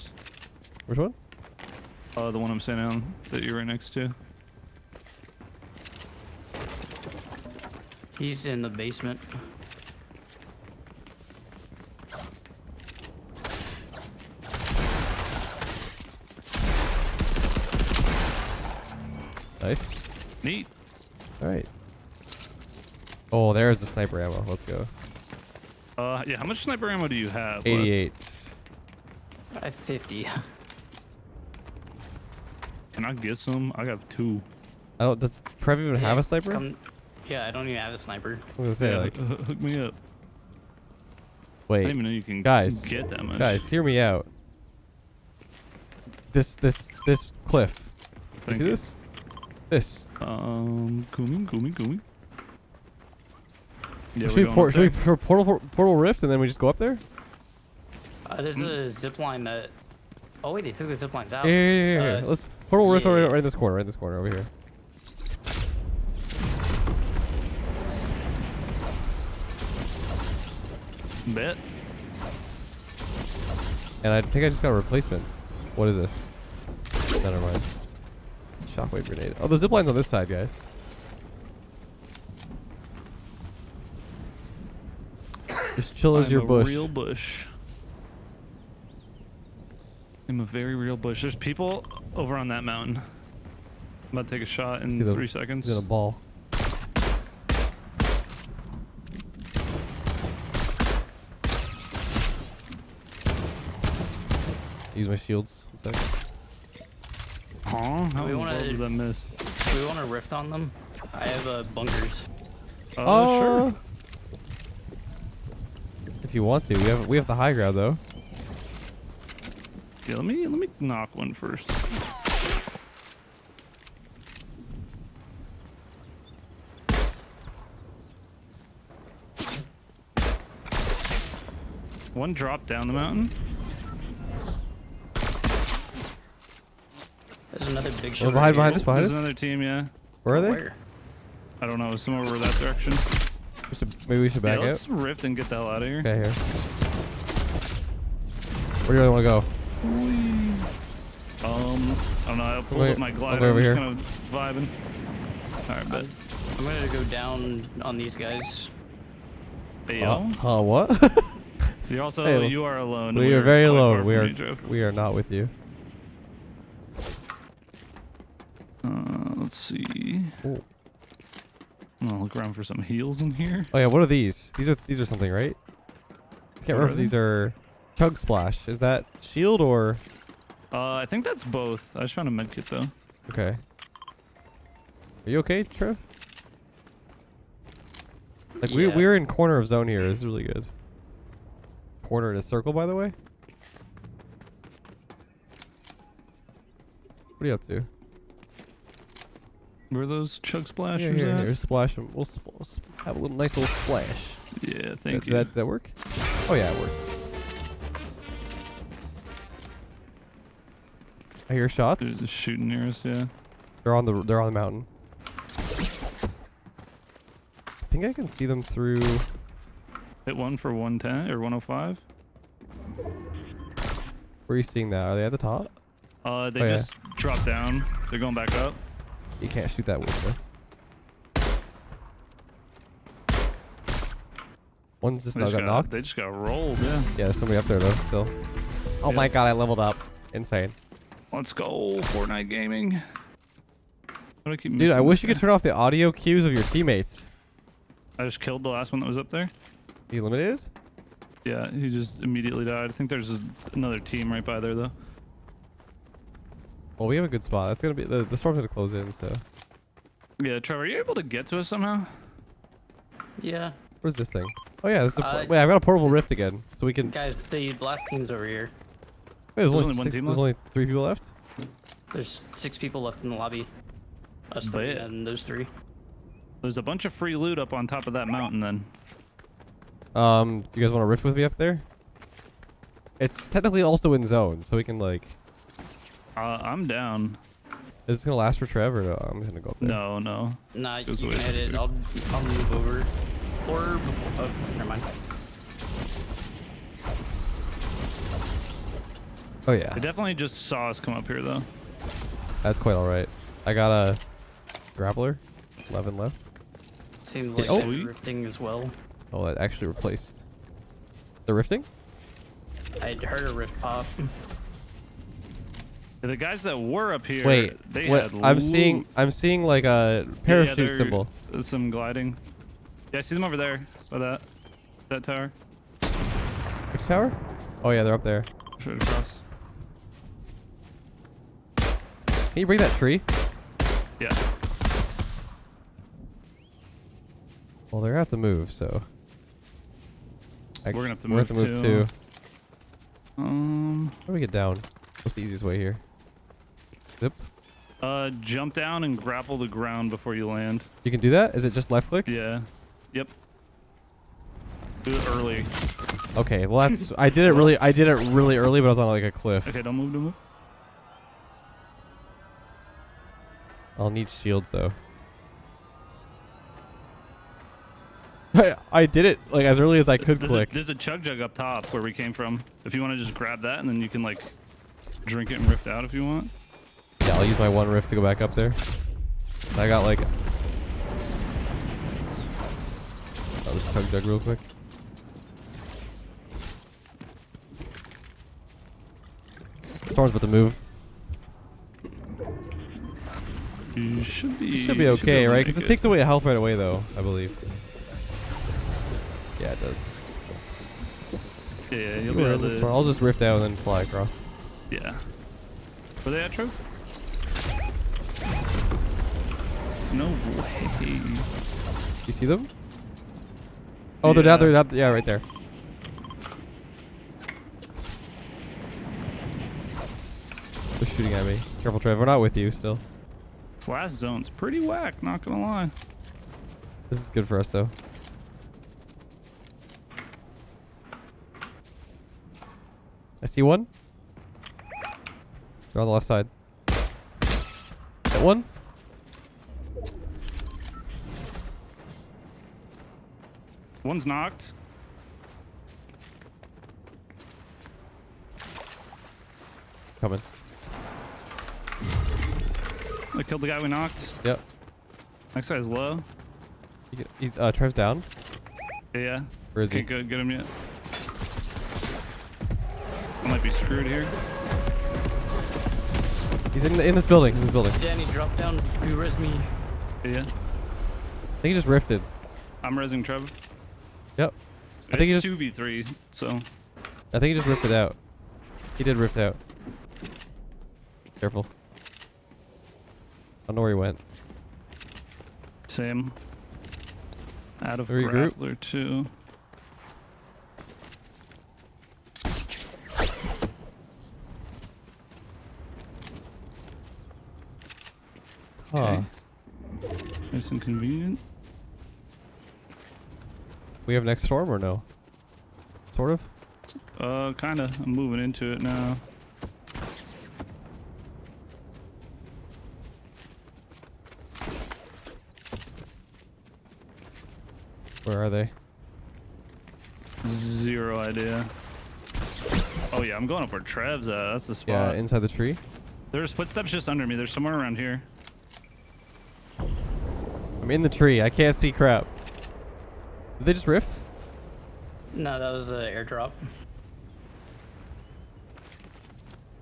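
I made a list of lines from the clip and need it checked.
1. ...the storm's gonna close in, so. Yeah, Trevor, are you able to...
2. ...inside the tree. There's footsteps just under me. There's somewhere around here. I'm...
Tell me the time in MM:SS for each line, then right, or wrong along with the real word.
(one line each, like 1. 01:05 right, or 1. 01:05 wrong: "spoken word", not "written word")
1. 04:18 right
2. 08:45 right.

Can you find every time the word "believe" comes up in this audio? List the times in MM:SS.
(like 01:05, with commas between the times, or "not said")
06:37.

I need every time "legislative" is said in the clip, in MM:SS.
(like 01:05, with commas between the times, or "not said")
not said.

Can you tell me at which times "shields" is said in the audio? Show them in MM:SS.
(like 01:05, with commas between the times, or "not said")
01:45, 02:59, 06:04.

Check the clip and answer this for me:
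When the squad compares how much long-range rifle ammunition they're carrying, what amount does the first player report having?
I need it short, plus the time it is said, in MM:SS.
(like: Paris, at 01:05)
88, at 00:27.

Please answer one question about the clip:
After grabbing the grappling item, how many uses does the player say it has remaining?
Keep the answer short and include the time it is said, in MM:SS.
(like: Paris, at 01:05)
11, at 05:05.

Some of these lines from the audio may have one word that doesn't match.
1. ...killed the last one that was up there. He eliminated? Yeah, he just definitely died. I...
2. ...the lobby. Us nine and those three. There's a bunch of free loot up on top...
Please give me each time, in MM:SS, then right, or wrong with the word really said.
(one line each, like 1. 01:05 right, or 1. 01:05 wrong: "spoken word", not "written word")
1. 04:08 wrong: "immediately", not "definitely"
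2. 04:33 wrong: "three", not "nine".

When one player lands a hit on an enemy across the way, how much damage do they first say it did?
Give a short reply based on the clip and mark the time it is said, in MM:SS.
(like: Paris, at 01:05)
110, at 03:40.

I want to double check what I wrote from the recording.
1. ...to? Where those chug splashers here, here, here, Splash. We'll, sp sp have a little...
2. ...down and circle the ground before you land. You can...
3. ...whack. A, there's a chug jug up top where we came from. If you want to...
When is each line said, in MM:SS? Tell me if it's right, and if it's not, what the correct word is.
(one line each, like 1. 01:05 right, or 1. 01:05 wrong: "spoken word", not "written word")
1. 03:17 right
2. 05:48 wrong: "grapple", not "circle"
3. 06:10 wrong: "click", not "whack".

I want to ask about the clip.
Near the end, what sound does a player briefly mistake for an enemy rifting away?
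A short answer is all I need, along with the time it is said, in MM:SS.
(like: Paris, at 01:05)
An airdrop, at 08:56.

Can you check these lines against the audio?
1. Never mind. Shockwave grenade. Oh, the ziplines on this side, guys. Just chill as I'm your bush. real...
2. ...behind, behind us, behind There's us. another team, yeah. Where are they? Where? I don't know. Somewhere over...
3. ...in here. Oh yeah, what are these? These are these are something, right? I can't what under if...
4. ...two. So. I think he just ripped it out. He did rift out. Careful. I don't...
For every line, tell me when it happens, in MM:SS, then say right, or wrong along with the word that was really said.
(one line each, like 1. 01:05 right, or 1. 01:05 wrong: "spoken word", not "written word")
1. 01:17 right
2. 02:18 right
3. 02:53 wrong: "remember", not "under"
4. 07:55 wrong: "three", not "two".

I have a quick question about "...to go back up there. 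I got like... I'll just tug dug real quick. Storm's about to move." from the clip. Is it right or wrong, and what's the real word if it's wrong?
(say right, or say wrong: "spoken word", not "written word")
right.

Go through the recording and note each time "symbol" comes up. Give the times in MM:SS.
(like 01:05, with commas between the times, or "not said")
05:20.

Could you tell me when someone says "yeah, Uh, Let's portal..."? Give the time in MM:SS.
01:02.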